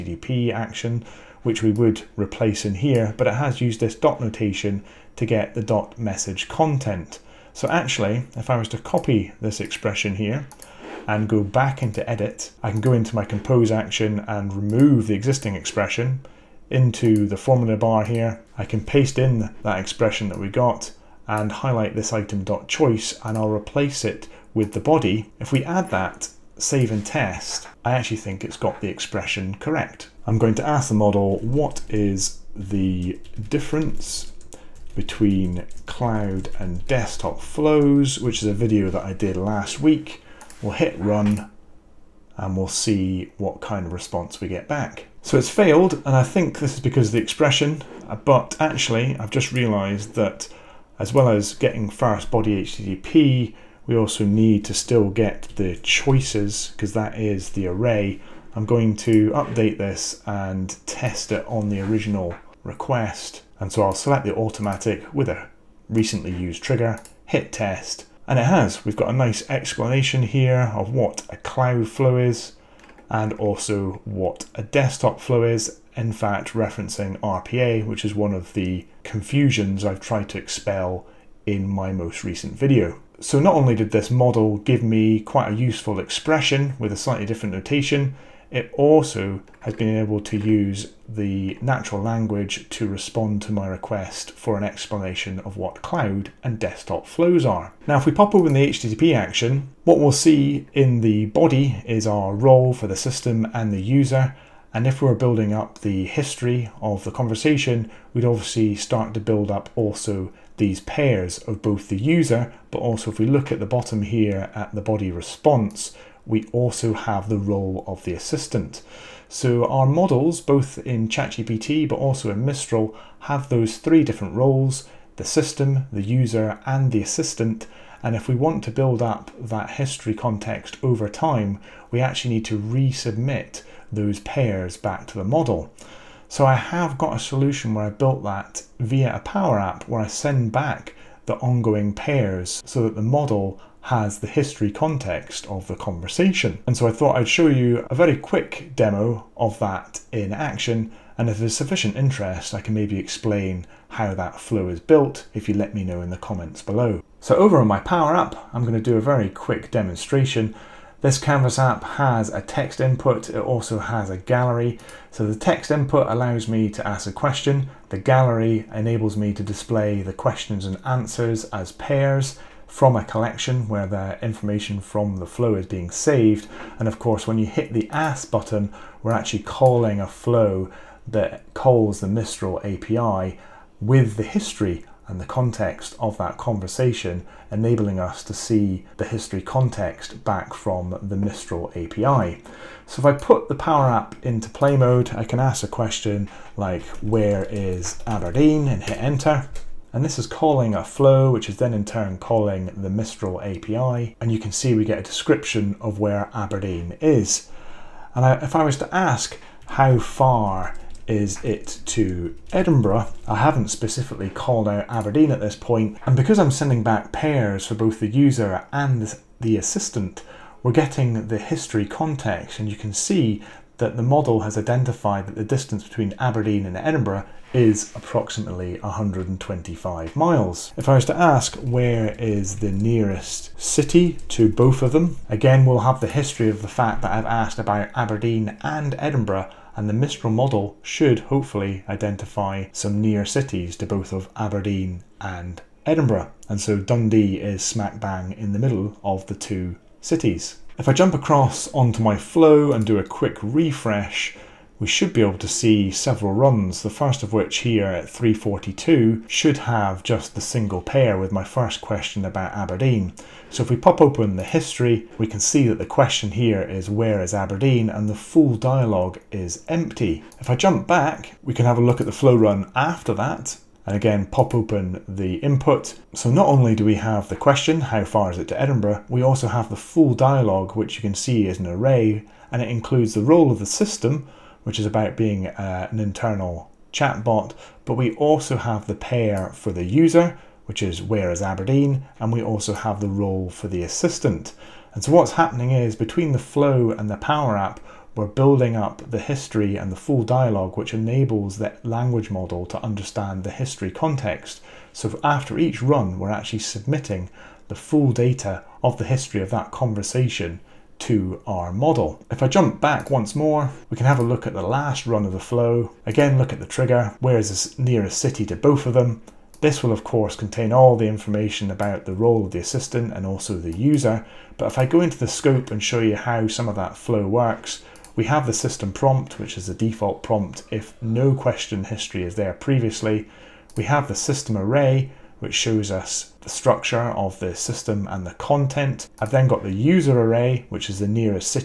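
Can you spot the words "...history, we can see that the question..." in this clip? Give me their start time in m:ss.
4:24.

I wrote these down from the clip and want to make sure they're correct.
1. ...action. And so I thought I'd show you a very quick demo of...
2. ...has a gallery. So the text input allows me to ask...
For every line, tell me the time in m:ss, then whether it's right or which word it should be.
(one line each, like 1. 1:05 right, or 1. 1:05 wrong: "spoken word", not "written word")
1. 2:25 wrong: "conversation", not "action"
2. 2:43 right.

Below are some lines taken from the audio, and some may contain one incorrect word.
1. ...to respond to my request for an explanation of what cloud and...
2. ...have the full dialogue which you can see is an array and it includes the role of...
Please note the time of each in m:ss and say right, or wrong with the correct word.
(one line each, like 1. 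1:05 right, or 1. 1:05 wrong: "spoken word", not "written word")
1. 1:32 right
2. 4:39 right.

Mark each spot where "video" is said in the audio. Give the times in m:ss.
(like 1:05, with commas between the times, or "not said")
0:38, 1:22.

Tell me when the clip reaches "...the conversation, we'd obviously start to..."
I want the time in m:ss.
1:47.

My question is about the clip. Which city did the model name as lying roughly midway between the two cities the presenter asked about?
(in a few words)
Dundee.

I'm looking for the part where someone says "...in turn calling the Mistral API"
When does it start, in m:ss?
3:21.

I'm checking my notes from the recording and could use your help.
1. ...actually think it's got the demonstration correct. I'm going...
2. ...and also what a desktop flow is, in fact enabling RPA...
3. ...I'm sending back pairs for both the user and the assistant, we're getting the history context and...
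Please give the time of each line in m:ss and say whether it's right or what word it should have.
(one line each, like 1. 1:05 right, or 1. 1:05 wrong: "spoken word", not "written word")
1. 0:27 wrong: "expression", not "demonstration"
2. 1:13 wrong: "referencing", not "enabling"
3. 3:36 right.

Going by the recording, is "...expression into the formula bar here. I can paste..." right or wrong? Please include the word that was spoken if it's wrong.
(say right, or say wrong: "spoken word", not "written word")
right.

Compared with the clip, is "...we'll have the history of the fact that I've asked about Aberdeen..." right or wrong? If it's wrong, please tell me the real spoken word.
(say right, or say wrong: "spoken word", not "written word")
right.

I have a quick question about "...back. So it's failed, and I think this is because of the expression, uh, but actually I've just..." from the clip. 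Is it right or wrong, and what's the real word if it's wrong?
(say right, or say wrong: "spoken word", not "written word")
right.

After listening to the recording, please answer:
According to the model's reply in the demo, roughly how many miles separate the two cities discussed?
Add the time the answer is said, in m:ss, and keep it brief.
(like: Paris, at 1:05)
125 miles, at 3:47.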